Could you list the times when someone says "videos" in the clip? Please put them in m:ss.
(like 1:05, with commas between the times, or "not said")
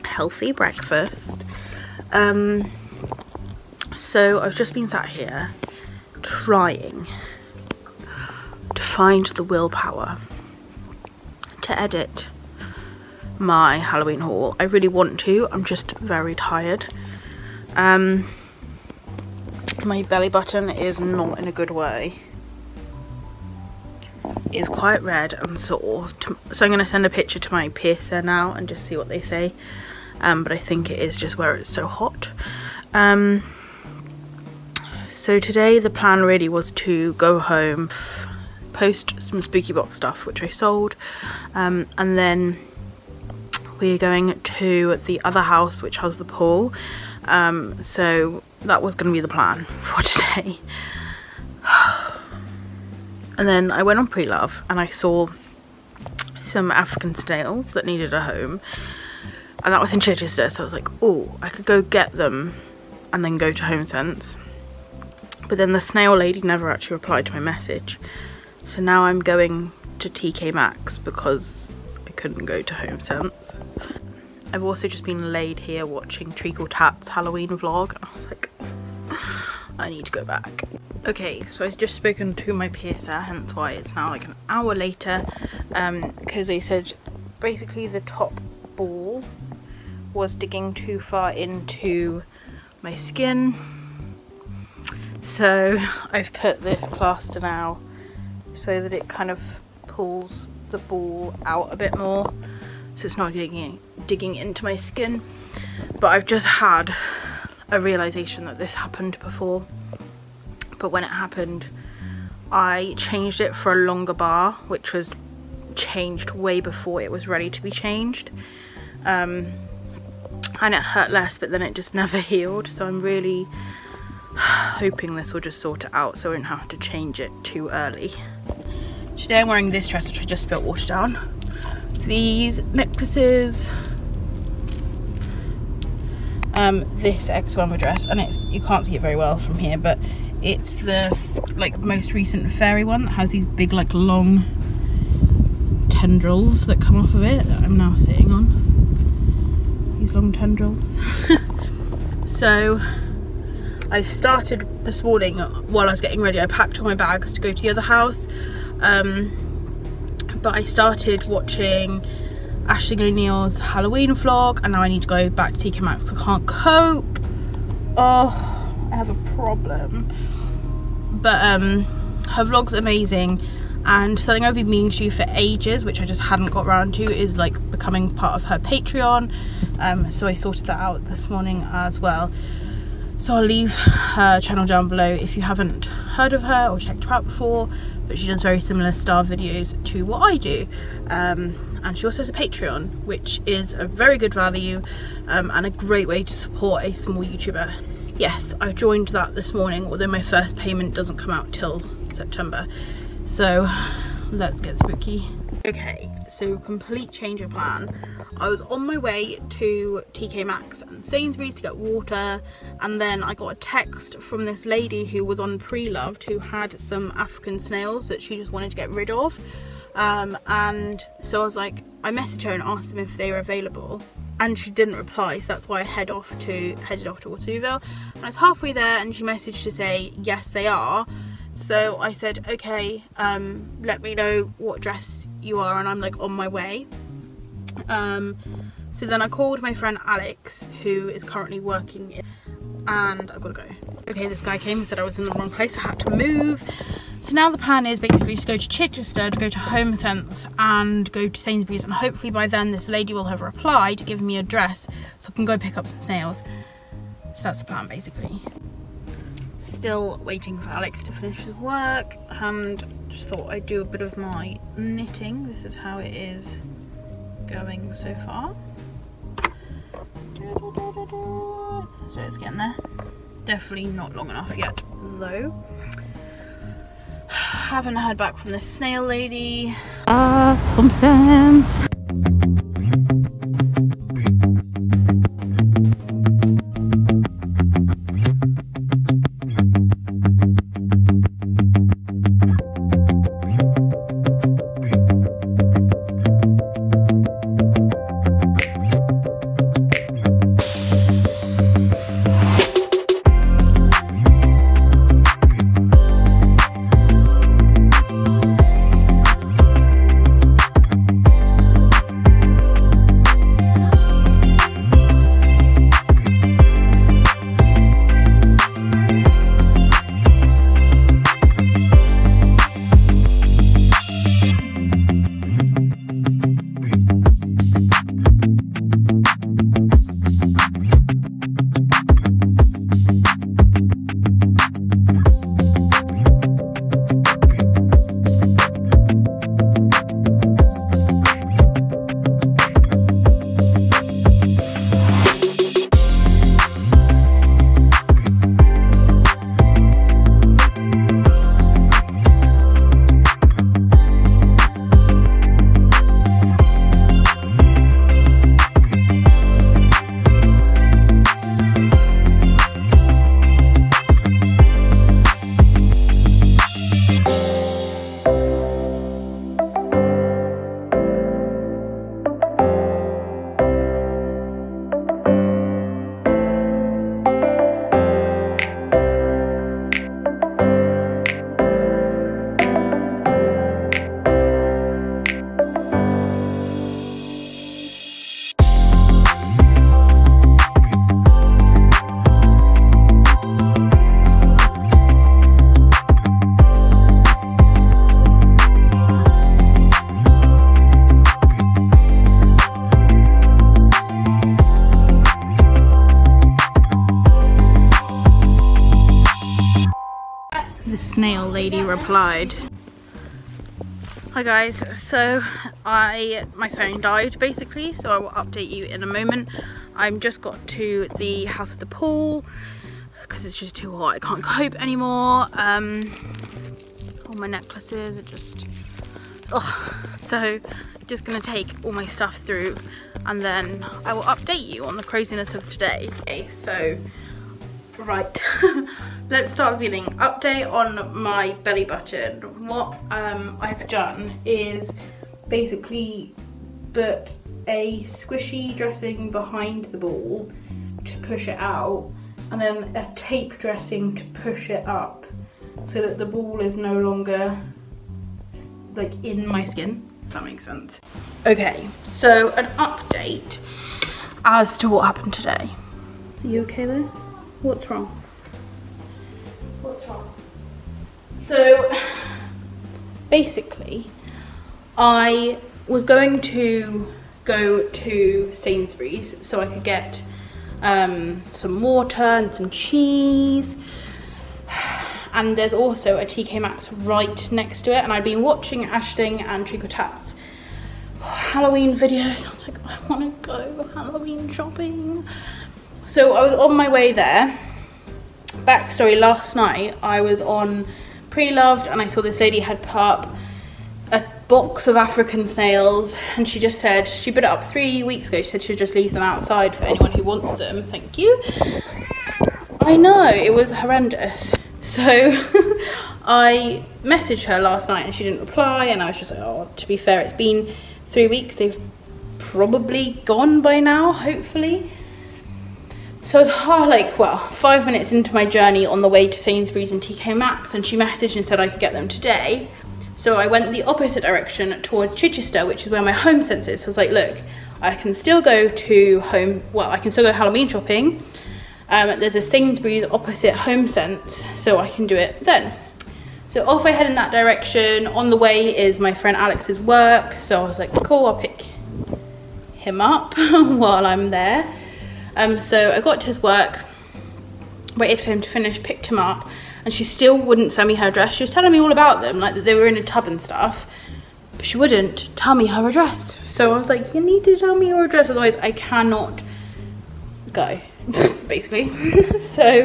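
3:09, 8:11.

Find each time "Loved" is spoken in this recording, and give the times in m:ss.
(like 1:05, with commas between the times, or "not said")
0:54, 3:35, 8:21.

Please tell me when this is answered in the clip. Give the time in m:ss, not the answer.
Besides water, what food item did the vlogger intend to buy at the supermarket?
8:02.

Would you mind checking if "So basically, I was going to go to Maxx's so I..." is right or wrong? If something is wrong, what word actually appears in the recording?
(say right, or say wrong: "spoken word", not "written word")
wrong: "Sainsbury", not "Maxx".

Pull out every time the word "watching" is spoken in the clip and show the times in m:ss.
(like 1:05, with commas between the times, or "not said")
1:15, 2:41, 8:08.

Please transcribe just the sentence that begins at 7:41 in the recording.
Okay, so an update as to what happened today.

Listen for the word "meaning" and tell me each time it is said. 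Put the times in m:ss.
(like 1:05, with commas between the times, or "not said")
2:54.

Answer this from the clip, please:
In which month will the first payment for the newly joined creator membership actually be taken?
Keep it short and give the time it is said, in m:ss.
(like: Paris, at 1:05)
September, at 3:22.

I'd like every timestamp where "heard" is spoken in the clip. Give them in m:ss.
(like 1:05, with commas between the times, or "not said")
3:05, 4:37.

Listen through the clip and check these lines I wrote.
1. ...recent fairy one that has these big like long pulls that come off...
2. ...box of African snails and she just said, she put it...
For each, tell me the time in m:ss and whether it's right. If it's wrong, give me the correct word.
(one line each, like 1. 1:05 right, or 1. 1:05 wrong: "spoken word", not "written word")
1. 2:22 wrong: "tendrils", not "pulls"
2. 8:24 right.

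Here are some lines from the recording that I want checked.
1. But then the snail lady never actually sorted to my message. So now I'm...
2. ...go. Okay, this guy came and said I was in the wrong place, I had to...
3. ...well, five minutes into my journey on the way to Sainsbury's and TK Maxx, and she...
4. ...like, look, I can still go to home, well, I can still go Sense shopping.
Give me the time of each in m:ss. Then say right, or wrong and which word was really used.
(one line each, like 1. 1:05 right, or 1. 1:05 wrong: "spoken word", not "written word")
1. 1:05 wrong: "replied", not "sorted"
2. 4:03 right
3. 8:47 right
4. 8:56 wrong: "Halloween", not "Sense".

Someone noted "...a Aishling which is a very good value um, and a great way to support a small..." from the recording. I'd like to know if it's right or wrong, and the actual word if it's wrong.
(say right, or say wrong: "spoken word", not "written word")
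wrong: "Patreon", not "Aishling".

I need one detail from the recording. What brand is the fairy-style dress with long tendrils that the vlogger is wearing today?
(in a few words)
X1.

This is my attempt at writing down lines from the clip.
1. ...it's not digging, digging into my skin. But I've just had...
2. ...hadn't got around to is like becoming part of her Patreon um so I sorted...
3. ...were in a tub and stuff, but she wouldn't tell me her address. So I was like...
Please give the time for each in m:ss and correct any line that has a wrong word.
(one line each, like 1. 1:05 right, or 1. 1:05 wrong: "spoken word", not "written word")
1. 1:43 right
2. 2:56 right
3. 9:22 right.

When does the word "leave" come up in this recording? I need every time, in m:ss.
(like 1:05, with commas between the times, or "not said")
3:03, 8:28.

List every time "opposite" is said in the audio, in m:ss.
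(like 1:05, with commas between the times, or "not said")
8:53, 9:03.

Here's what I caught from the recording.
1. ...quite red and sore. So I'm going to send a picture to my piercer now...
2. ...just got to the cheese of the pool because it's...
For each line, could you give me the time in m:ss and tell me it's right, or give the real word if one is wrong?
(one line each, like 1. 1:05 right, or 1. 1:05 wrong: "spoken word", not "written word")
1. 0:24 right
2. 7:00 wrong: "house", not "cheese".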